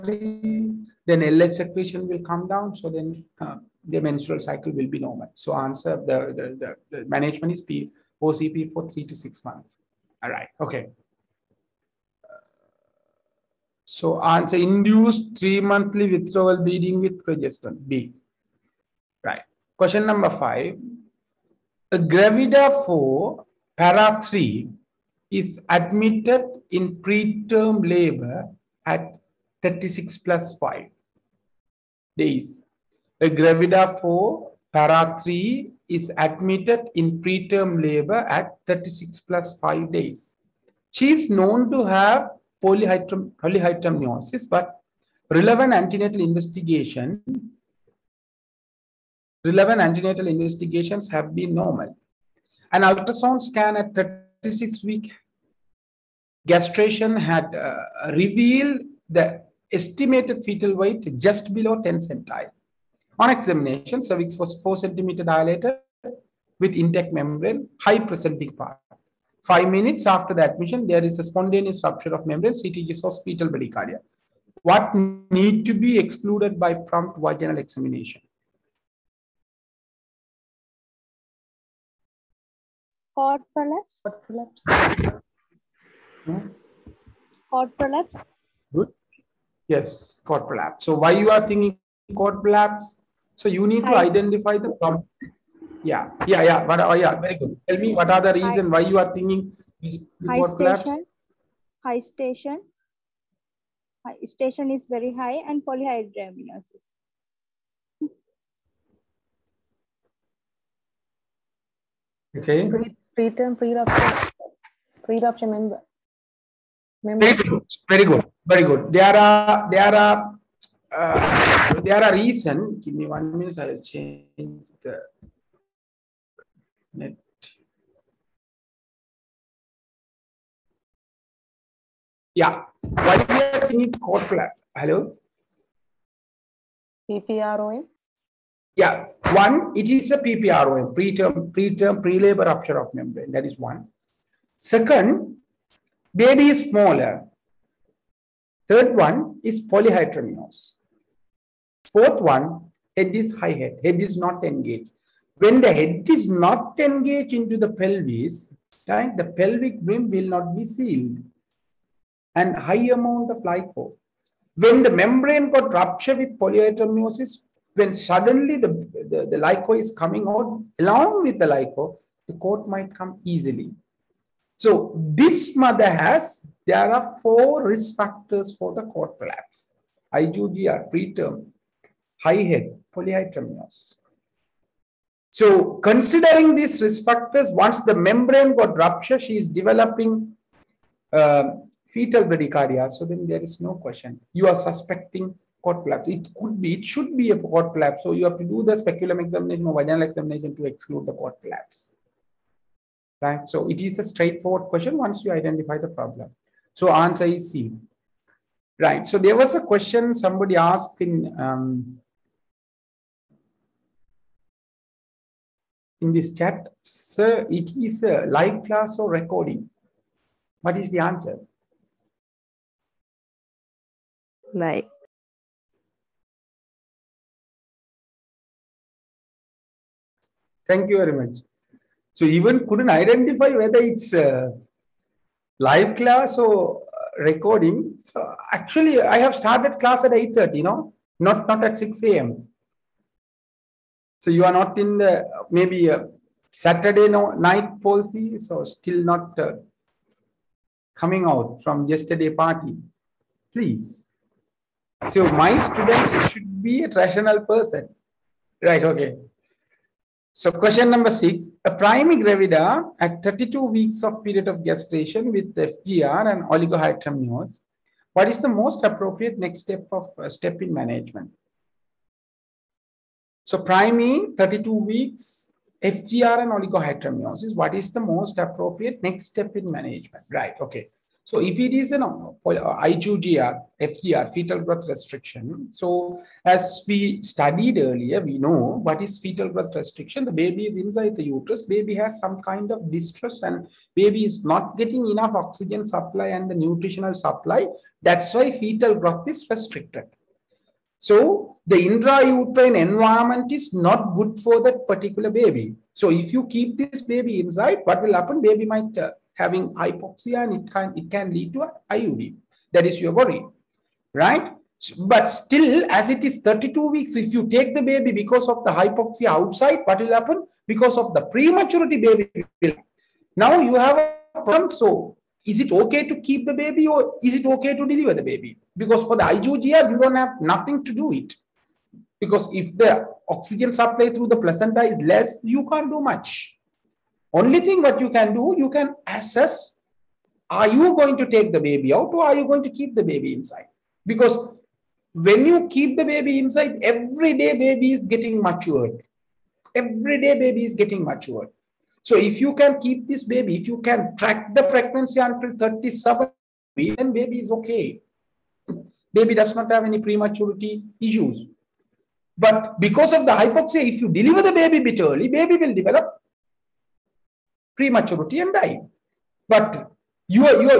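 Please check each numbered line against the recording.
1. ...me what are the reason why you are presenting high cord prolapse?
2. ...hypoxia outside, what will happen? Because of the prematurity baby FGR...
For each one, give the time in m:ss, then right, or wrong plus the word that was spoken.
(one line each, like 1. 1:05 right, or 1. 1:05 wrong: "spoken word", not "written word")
1. 1:37 wrong: "thinking", not "presenting"
2. 5:18 wrong: "Now", not "FGR".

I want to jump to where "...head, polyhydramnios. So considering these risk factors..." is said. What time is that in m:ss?
3:02.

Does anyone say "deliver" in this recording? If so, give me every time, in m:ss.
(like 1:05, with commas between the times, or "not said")
5:27, 6:04.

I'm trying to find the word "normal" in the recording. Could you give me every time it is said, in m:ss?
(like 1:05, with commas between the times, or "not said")
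0:04, 0:51.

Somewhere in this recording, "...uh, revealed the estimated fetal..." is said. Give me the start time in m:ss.
0:57.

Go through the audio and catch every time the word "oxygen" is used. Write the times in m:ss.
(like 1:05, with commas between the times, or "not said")
4:55, 5:33.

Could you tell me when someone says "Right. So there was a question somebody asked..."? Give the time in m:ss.
3:28.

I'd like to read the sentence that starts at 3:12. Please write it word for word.
So then there is no question.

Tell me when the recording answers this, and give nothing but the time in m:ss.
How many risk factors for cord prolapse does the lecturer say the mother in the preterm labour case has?
2:57.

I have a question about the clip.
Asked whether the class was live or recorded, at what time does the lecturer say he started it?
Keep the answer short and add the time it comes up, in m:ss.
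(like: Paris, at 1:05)
8.30, at 4:00.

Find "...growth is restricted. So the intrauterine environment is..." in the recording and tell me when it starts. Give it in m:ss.
4:58.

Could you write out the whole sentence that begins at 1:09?
Five minutes after the admission, there is a spontaneous rupture of membrane, CTG of fetal bradycardia.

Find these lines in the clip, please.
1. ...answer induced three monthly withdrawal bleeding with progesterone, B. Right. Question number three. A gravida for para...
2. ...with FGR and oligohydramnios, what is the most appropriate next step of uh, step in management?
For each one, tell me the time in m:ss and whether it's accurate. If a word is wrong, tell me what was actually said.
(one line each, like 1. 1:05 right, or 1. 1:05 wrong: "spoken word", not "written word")
1. 0:14 wrong: "five", not "three"
2. 4:25 right.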